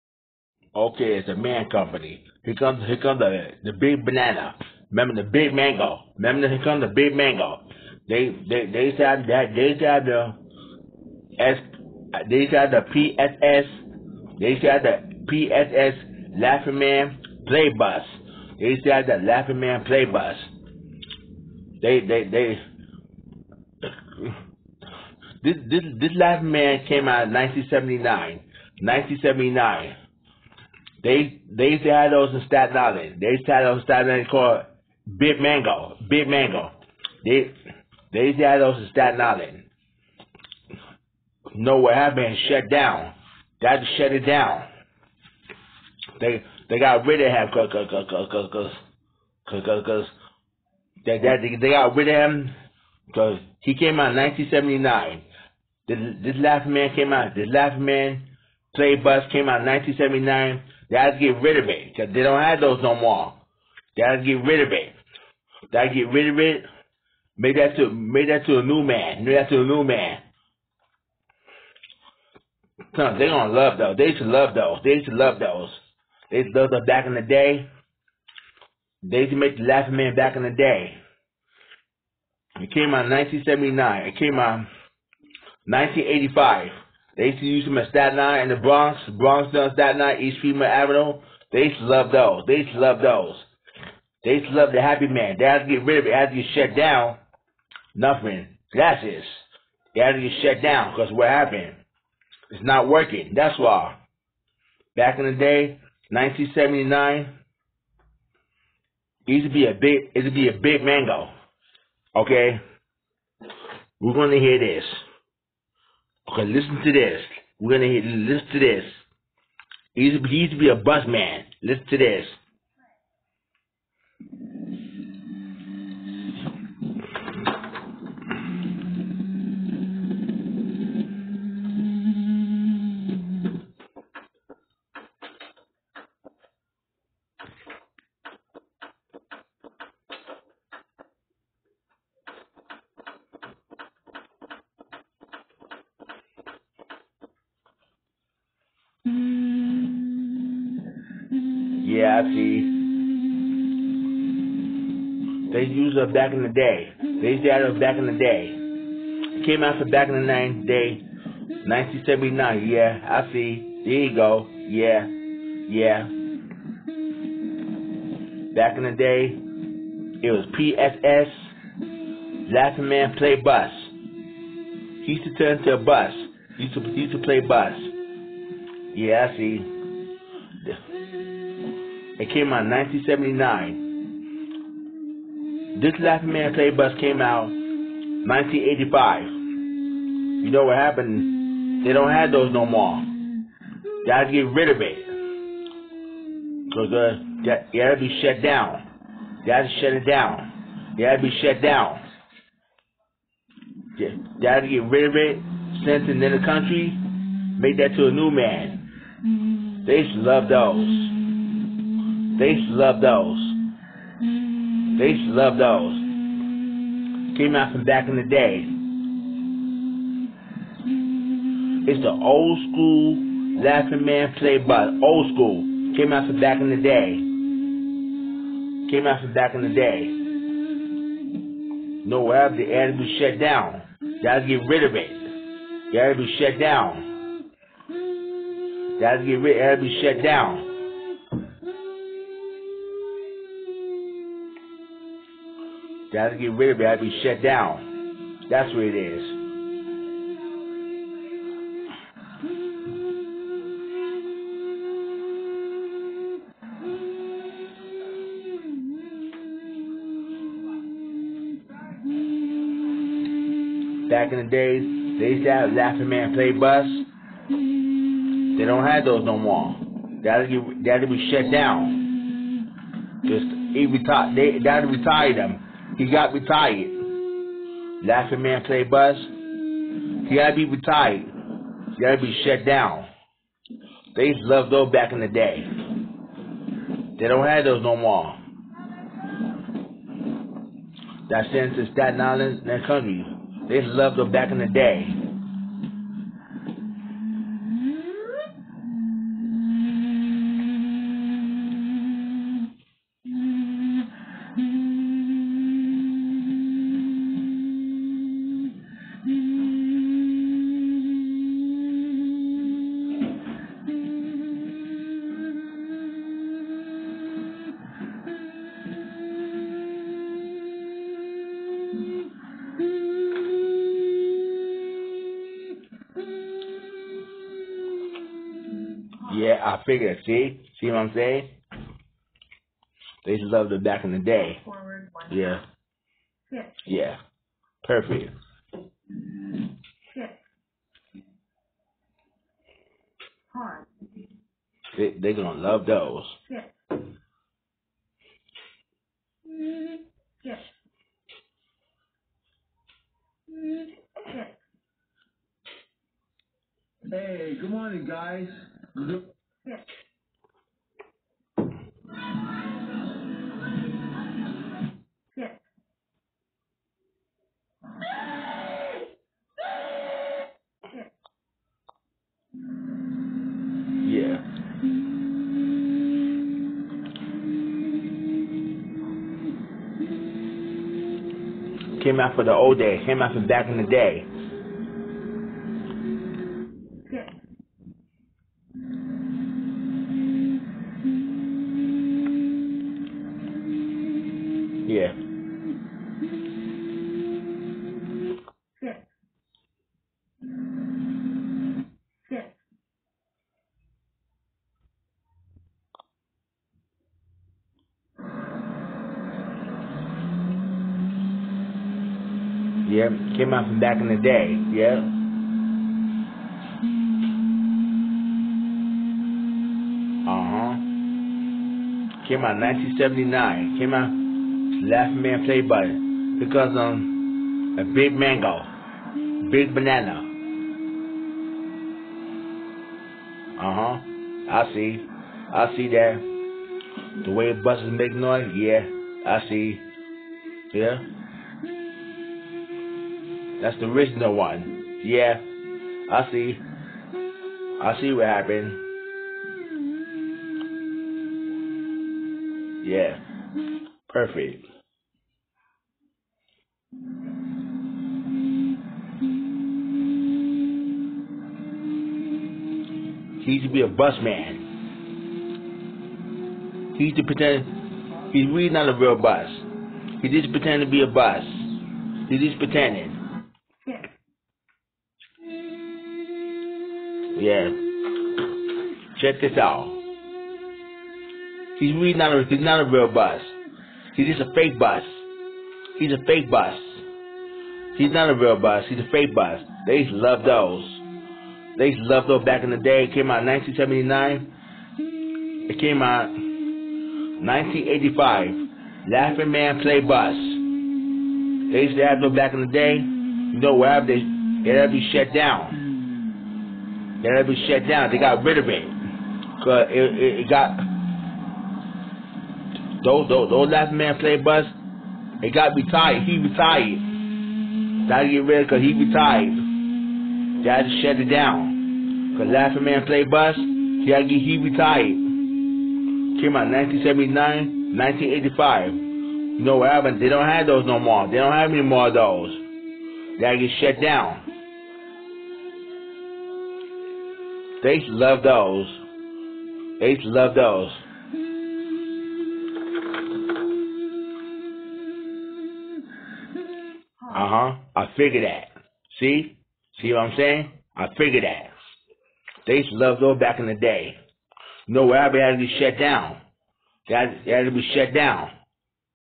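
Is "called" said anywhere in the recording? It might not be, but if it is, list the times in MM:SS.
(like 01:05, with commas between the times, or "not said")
00:34.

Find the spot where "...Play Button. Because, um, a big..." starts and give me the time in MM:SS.
07:05.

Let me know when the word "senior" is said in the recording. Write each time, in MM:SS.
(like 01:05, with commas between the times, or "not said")
not said.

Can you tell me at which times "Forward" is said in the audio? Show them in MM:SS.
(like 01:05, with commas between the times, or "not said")
05:34.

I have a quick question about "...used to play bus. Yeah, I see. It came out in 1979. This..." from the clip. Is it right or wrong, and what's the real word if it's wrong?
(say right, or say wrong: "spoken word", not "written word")
right.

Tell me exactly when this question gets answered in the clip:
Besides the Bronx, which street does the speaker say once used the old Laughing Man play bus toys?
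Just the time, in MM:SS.
01:30.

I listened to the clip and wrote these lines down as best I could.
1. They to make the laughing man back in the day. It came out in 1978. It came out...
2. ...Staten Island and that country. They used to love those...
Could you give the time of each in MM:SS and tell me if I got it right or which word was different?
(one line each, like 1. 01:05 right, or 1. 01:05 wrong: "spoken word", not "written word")
1. 01:19 wrong: "1979", not "1978"
2. 04:51 right.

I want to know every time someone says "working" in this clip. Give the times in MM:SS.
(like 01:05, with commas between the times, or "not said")
01:42.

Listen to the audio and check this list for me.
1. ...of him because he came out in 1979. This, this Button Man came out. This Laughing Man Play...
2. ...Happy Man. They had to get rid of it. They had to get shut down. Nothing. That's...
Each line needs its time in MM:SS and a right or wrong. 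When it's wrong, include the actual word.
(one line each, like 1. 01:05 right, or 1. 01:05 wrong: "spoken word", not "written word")
1. 00:52 wrong: "Laughing", not "Button"
2. 01:34 right.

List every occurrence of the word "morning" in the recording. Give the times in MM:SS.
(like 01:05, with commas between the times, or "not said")
05:57.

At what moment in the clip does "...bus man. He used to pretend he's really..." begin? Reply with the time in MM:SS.
07:43.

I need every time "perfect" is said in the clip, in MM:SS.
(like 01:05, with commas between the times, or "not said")
05:37, 07:34.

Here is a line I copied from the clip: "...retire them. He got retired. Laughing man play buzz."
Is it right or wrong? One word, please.
right.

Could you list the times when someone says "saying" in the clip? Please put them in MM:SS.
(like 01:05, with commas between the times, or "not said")
05:31, 09:10.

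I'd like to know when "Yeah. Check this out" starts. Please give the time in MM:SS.
07:57.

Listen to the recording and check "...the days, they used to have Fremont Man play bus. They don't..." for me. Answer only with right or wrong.
wrong.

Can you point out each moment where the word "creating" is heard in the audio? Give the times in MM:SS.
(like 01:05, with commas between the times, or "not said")
not said.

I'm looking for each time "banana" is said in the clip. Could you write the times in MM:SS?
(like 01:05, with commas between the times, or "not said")
00:04, 07:09.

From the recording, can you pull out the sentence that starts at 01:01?
Cause they don't have those no more.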